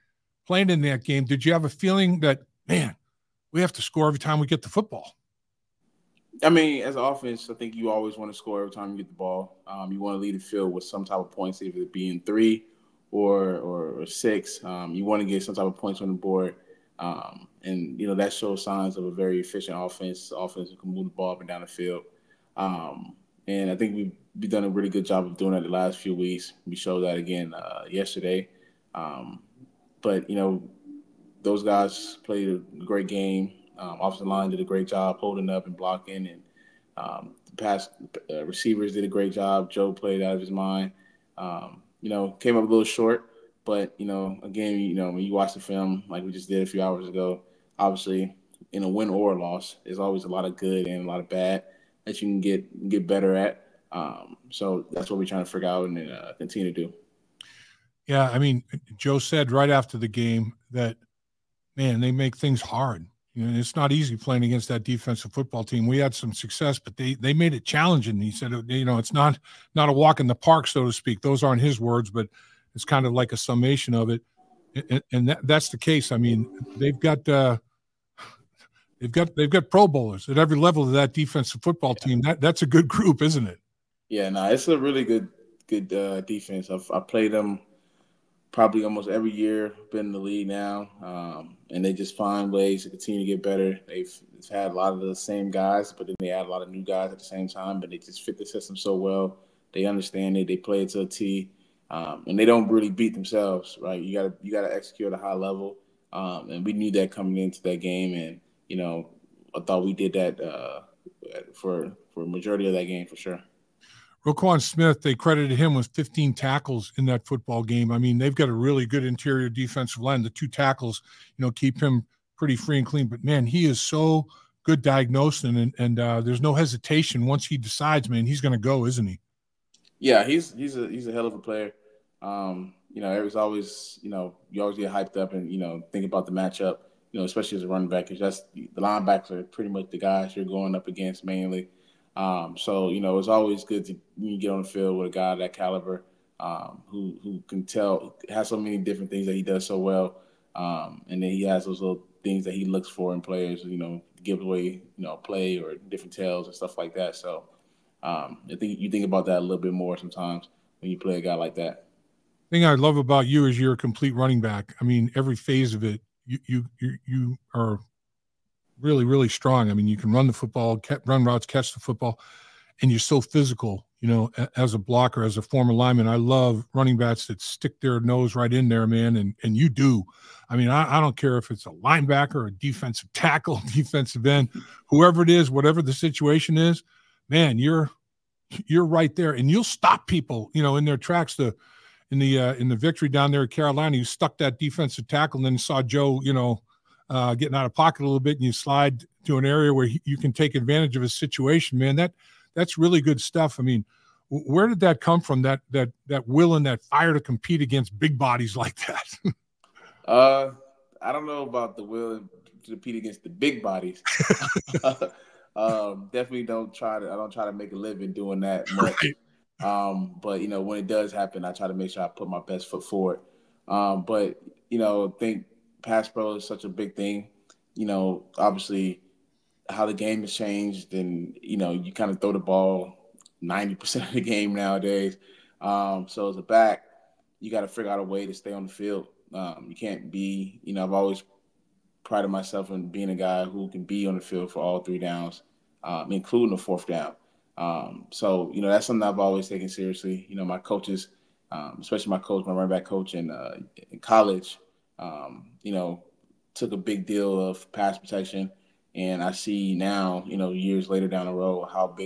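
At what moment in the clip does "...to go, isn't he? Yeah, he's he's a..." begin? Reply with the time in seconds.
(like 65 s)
128 s.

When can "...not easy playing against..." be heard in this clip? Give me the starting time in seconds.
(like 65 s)
63 s.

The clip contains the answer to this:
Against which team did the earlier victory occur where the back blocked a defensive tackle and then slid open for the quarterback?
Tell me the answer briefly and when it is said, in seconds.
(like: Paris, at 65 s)
Carolina, at 193 s.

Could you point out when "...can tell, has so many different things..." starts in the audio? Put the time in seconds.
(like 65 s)
147 s.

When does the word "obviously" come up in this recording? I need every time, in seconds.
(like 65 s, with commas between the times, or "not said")
47 s, 228 s.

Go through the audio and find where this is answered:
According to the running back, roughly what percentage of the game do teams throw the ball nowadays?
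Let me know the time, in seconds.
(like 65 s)
233 s.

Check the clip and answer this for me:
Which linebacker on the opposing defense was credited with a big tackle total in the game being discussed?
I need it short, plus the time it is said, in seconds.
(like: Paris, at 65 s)
Roquan Smith, at 114 s.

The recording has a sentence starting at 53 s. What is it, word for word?
Um, so that's what we're trying to figure out and uh, continue to do.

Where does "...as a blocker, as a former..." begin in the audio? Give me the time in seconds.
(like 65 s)
174 s.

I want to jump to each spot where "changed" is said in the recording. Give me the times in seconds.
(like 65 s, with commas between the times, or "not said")
230 s.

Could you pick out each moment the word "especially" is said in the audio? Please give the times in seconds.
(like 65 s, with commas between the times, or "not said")
137 s, 251 s.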